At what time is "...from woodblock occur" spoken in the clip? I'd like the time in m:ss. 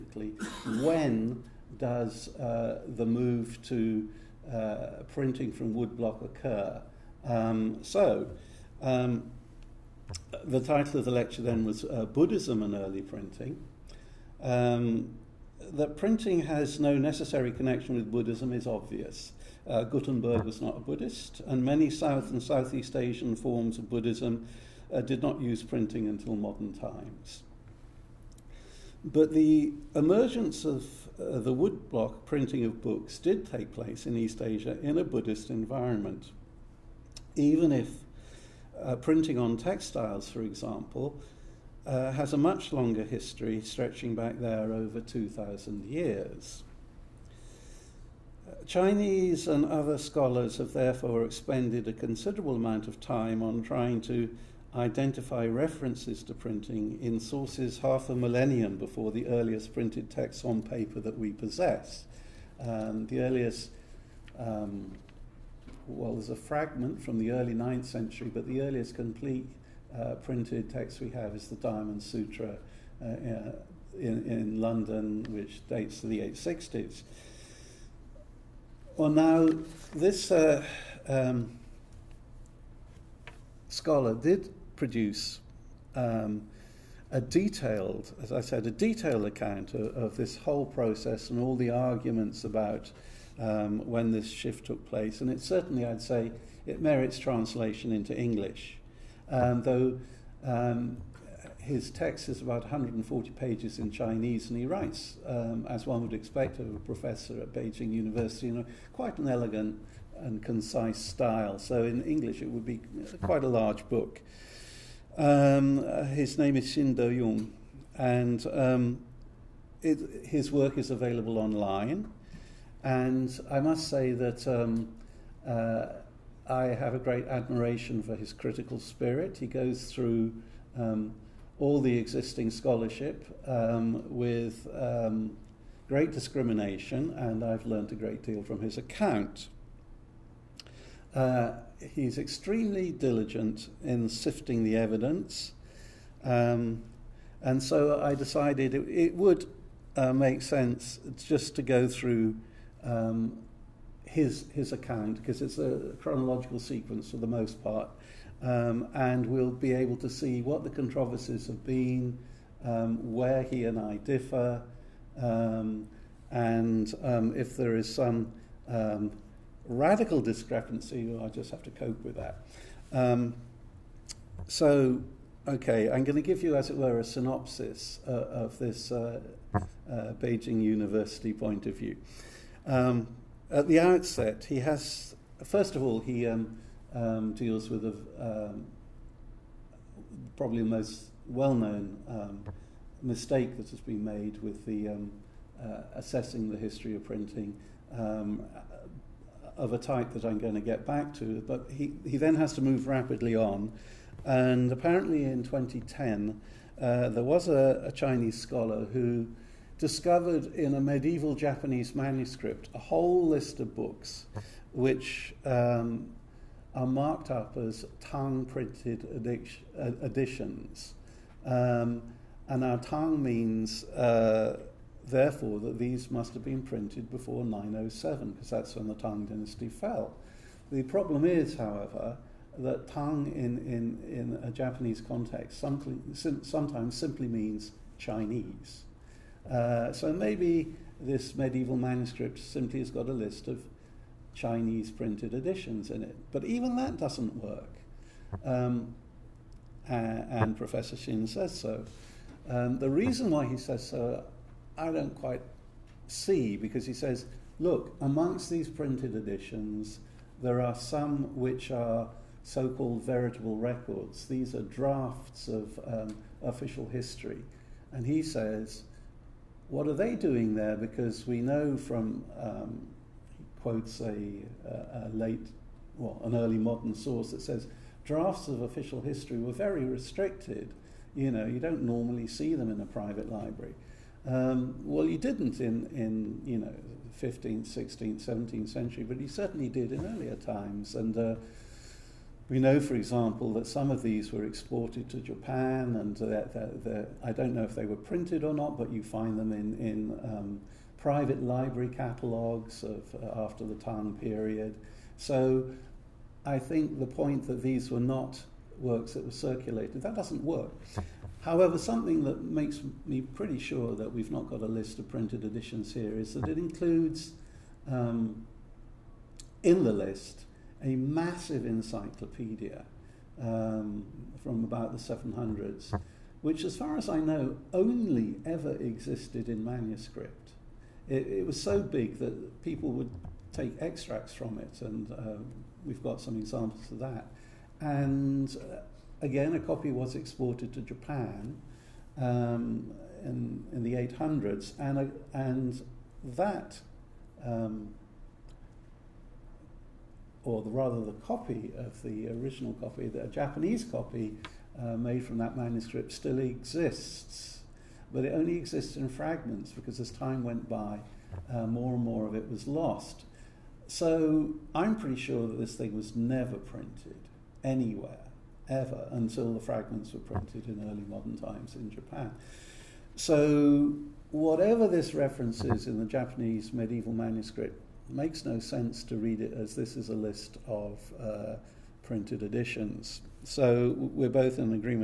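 0:05.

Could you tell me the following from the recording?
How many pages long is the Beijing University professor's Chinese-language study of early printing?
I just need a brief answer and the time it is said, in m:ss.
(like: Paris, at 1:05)
about 140 pages, at 1:42.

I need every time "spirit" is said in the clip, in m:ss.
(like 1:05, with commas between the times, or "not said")
2:08.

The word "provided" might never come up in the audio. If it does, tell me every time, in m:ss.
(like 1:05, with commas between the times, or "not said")
not said.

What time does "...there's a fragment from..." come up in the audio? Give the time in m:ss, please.
1:06.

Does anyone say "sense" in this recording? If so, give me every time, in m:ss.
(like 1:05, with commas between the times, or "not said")
2:30, 6:18.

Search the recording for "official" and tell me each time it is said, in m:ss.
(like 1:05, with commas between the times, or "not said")
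4:26, 4:38.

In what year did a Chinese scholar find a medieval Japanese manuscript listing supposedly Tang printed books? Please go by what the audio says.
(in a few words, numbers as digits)
2010.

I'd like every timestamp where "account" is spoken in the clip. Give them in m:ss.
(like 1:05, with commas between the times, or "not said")
1:29, 2:18, 2:34.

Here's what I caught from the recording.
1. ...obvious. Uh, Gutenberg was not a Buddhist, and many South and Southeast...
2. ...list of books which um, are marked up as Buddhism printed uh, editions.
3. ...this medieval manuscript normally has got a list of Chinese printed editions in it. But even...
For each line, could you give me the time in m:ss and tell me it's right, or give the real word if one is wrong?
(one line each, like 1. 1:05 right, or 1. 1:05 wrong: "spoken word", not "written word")
1. 0:18 right
2. 3:33 wrong: "Tang", not "Buddhism"
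3. 4:00 wrong: "simply", not "normally".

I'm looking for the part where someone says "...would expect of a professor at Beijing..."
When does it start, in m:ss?
1:46.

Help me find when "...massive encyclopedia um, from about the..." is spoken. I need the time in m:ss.
5:20.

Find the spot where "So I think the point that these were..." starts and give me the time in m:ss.
5:05.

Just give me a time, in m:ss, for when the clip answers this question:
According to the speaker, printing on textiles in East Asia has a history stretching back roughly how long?
0:44.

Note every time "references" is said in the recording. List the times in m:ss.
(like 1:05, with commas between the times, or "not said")
0:55, 6:15.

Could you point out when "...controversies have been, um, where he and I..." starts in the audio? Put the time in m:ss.
2:40.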